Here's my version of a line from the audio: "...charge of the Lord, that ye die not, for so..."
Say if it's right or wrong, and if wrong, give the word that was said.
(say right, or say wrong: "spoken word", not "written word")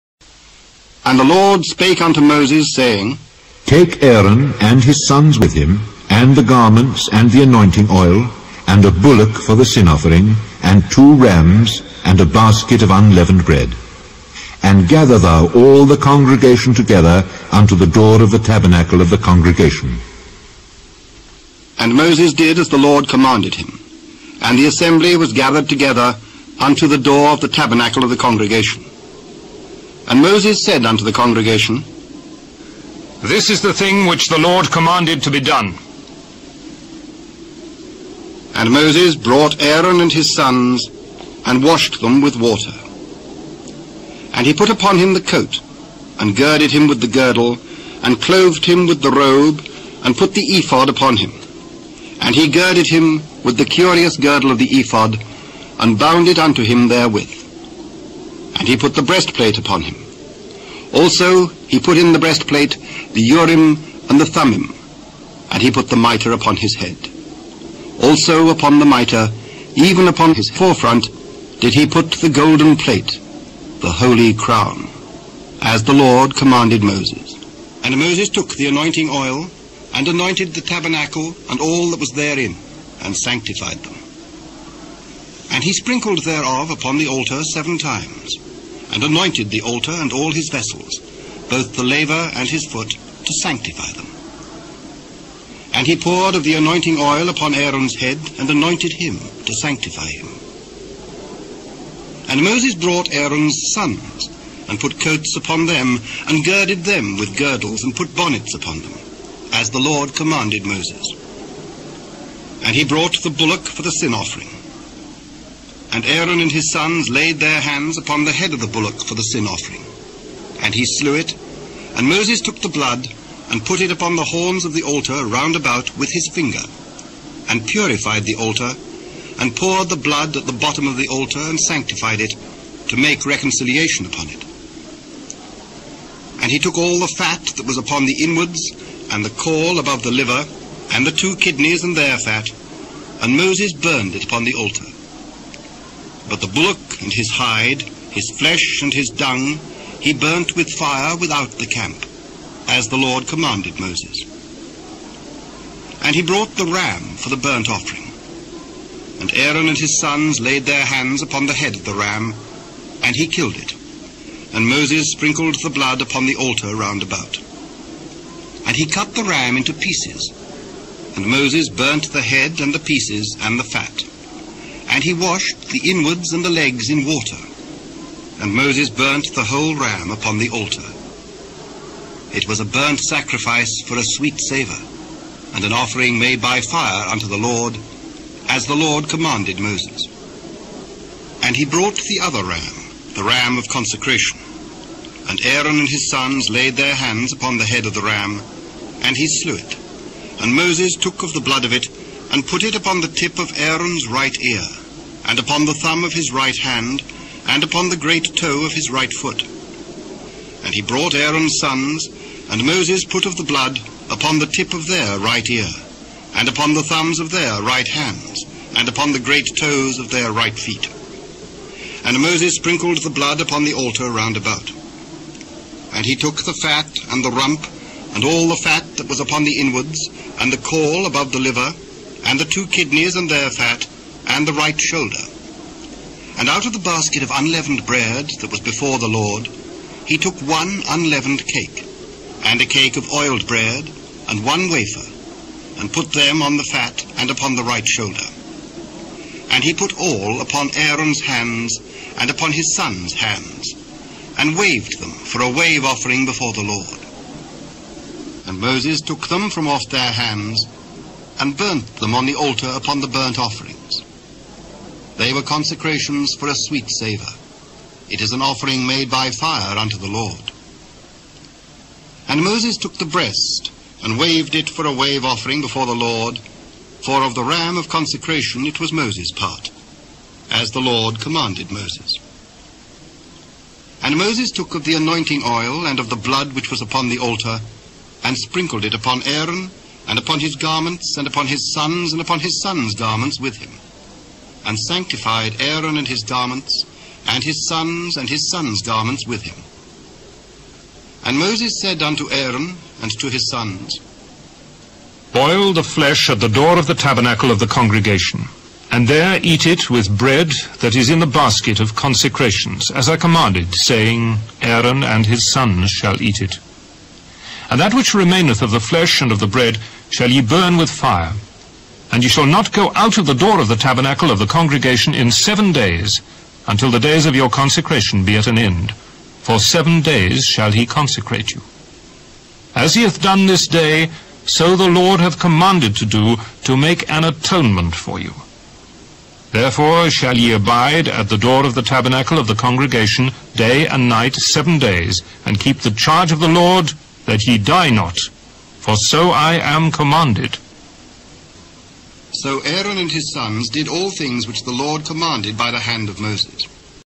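right.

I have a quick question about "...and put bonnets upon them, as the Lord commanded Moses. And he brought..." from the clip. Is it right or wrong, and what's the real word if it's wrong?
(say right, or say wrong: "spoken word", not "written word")
right.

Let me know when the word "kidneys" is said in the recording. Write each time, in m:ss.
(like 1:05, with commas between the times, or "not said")
2:21, 3:52.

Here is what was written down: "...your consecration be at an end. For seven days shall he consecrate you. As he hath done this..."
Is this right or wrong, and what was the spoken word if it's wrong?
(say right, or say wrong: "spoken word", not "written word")
right.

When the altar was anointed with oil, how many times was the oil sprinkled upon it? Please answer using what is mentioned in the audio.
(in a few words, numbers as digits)
7 times.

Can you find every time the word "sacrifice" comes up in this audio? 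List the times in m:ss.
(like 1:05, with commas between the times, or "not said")
3:02.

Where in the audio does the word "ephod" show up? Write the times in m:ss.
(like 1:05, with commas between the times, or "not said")
0:50, 0:54.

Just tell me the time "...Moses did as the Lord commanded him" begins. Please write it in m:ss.
0:21.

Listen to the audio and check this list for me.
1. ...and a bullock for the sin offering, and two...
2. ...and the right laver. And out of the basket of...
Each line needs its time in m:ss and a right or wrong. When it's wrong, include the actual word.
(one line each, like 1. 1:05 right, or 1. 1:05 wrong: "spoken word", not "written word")
1. 0:08 right
2. 3:54 wrong: "shoulder", not "laver".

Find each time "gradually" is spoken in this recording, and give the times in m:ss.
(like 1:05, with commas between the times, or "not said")
not said.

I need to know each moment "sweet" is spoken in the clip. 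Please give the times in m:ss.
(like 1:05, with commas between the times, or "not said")
3:04, 4:26.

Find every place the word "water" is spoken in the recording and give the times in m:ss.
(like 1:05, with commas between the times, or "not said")
0:42, 2:57.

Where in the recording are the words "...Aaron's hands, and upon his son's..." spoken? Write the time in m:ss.
4:10.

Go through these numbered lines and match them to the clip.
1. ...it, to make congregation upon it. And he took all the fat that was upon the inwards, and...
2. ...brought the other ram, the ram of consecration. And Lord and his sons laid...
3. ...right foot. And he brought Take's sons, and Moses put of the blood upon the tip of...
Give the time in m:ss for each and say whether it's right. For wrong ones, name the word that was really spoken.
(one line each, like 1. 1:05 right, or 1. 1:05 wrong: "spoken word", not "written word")
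1. 2:12 wrong: "reconciliation", not "congregation"
2. 3:11 wrong: "Aaron", not "Lord"
3. 3:28 wrong: "Aaron", not "Take".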